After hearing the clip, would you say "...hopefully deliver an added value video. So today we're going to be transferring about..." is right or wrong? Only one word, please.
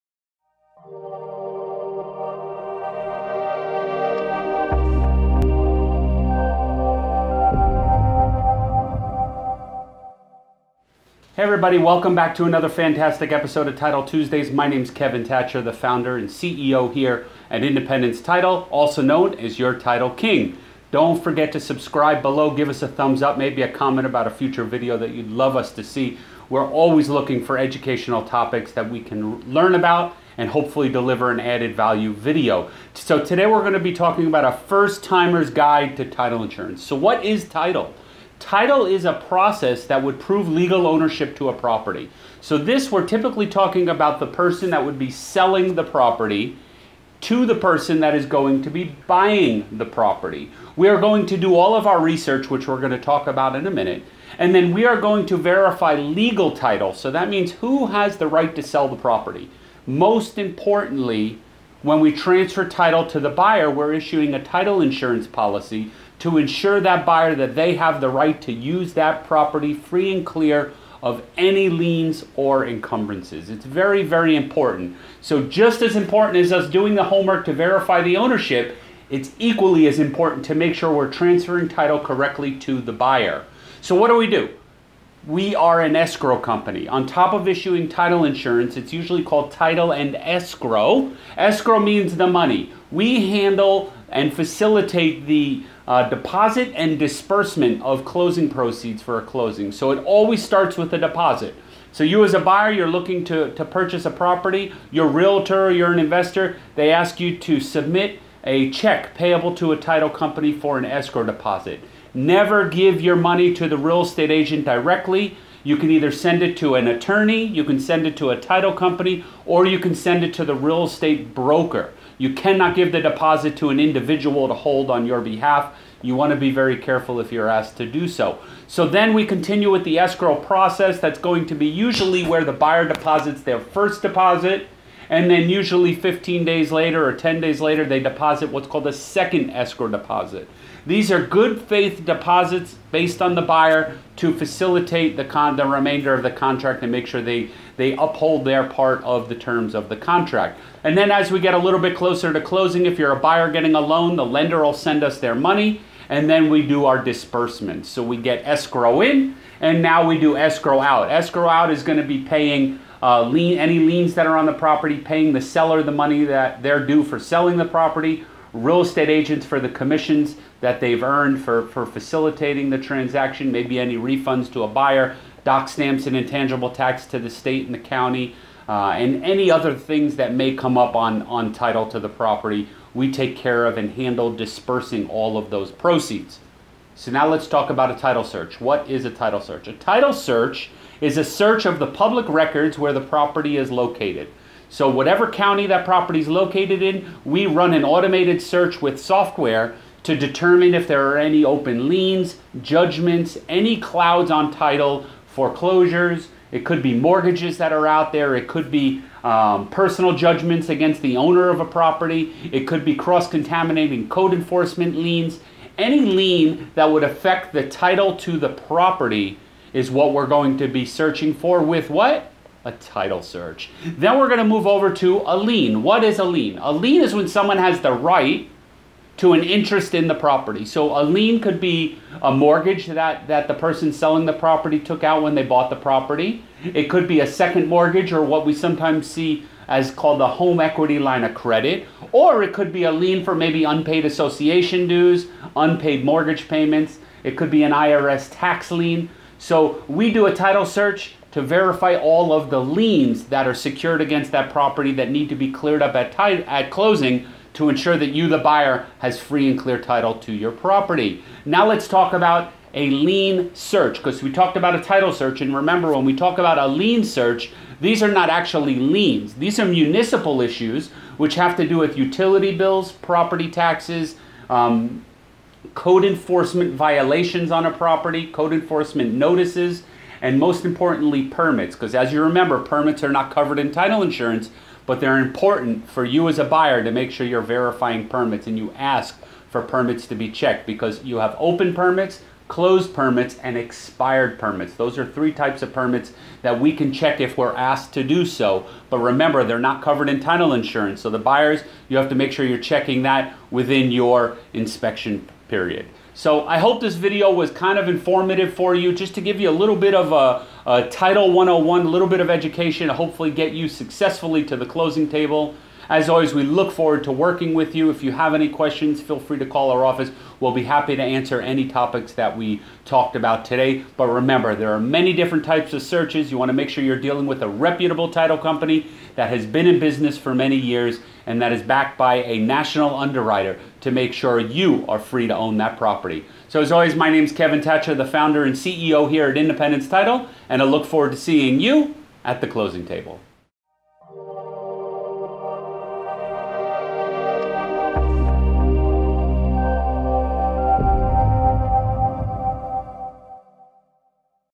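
wrong.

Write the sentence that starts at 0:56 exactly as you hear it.
So that means who has the right to sell the property.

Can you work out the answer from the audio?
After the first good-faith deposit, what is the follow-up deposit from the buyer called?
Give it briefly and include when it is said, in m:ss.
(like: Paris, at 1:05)
second escrow deposit, at 2:18.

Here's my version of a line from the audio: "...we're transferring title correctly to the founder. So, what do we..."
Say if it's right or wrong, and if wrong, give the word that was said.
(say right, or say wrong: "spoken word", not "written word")
wrong: "buyer", not "founder".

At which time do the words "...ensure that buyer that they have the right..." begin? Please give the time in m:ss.
1:06.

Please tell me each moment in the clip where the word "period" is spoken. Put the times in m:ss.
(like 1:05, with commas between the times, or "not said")
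5:05.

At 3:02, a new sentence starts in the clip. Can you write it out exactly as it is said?
We take care of and handle dispersing all of those proceeds.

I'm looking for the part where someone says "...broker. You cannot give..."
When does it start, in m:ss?
2:01.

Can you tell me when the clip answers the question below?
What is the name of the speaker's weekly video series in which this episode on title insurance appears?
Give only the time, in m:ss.
0:13.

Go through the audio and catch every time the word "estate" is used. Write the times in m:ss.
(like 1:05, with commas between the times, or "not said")
1:54, 2:00, 2:48.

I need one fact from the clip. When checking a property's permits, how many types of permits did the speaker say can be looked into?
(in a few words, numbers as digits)
3.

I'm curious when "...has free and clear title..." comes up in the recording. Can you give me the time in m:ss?
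4:18.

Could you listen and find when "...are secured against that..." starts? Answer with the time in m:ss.
4:13.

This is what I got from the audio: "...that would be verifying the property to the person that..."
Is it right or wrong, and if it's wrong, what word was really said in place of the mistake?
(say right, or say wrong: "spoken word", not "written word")
wrong: "selling", not "verifying".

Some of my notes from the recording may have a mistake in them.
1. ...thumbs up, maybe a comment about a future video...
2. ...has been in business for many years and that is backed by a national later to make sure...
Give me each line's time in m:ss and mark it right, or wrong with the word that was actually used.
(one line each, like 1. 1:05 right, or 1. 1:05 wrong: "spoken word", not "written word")
1. 0:22 right
2. 5:29 wrong: "underwriter", not "later".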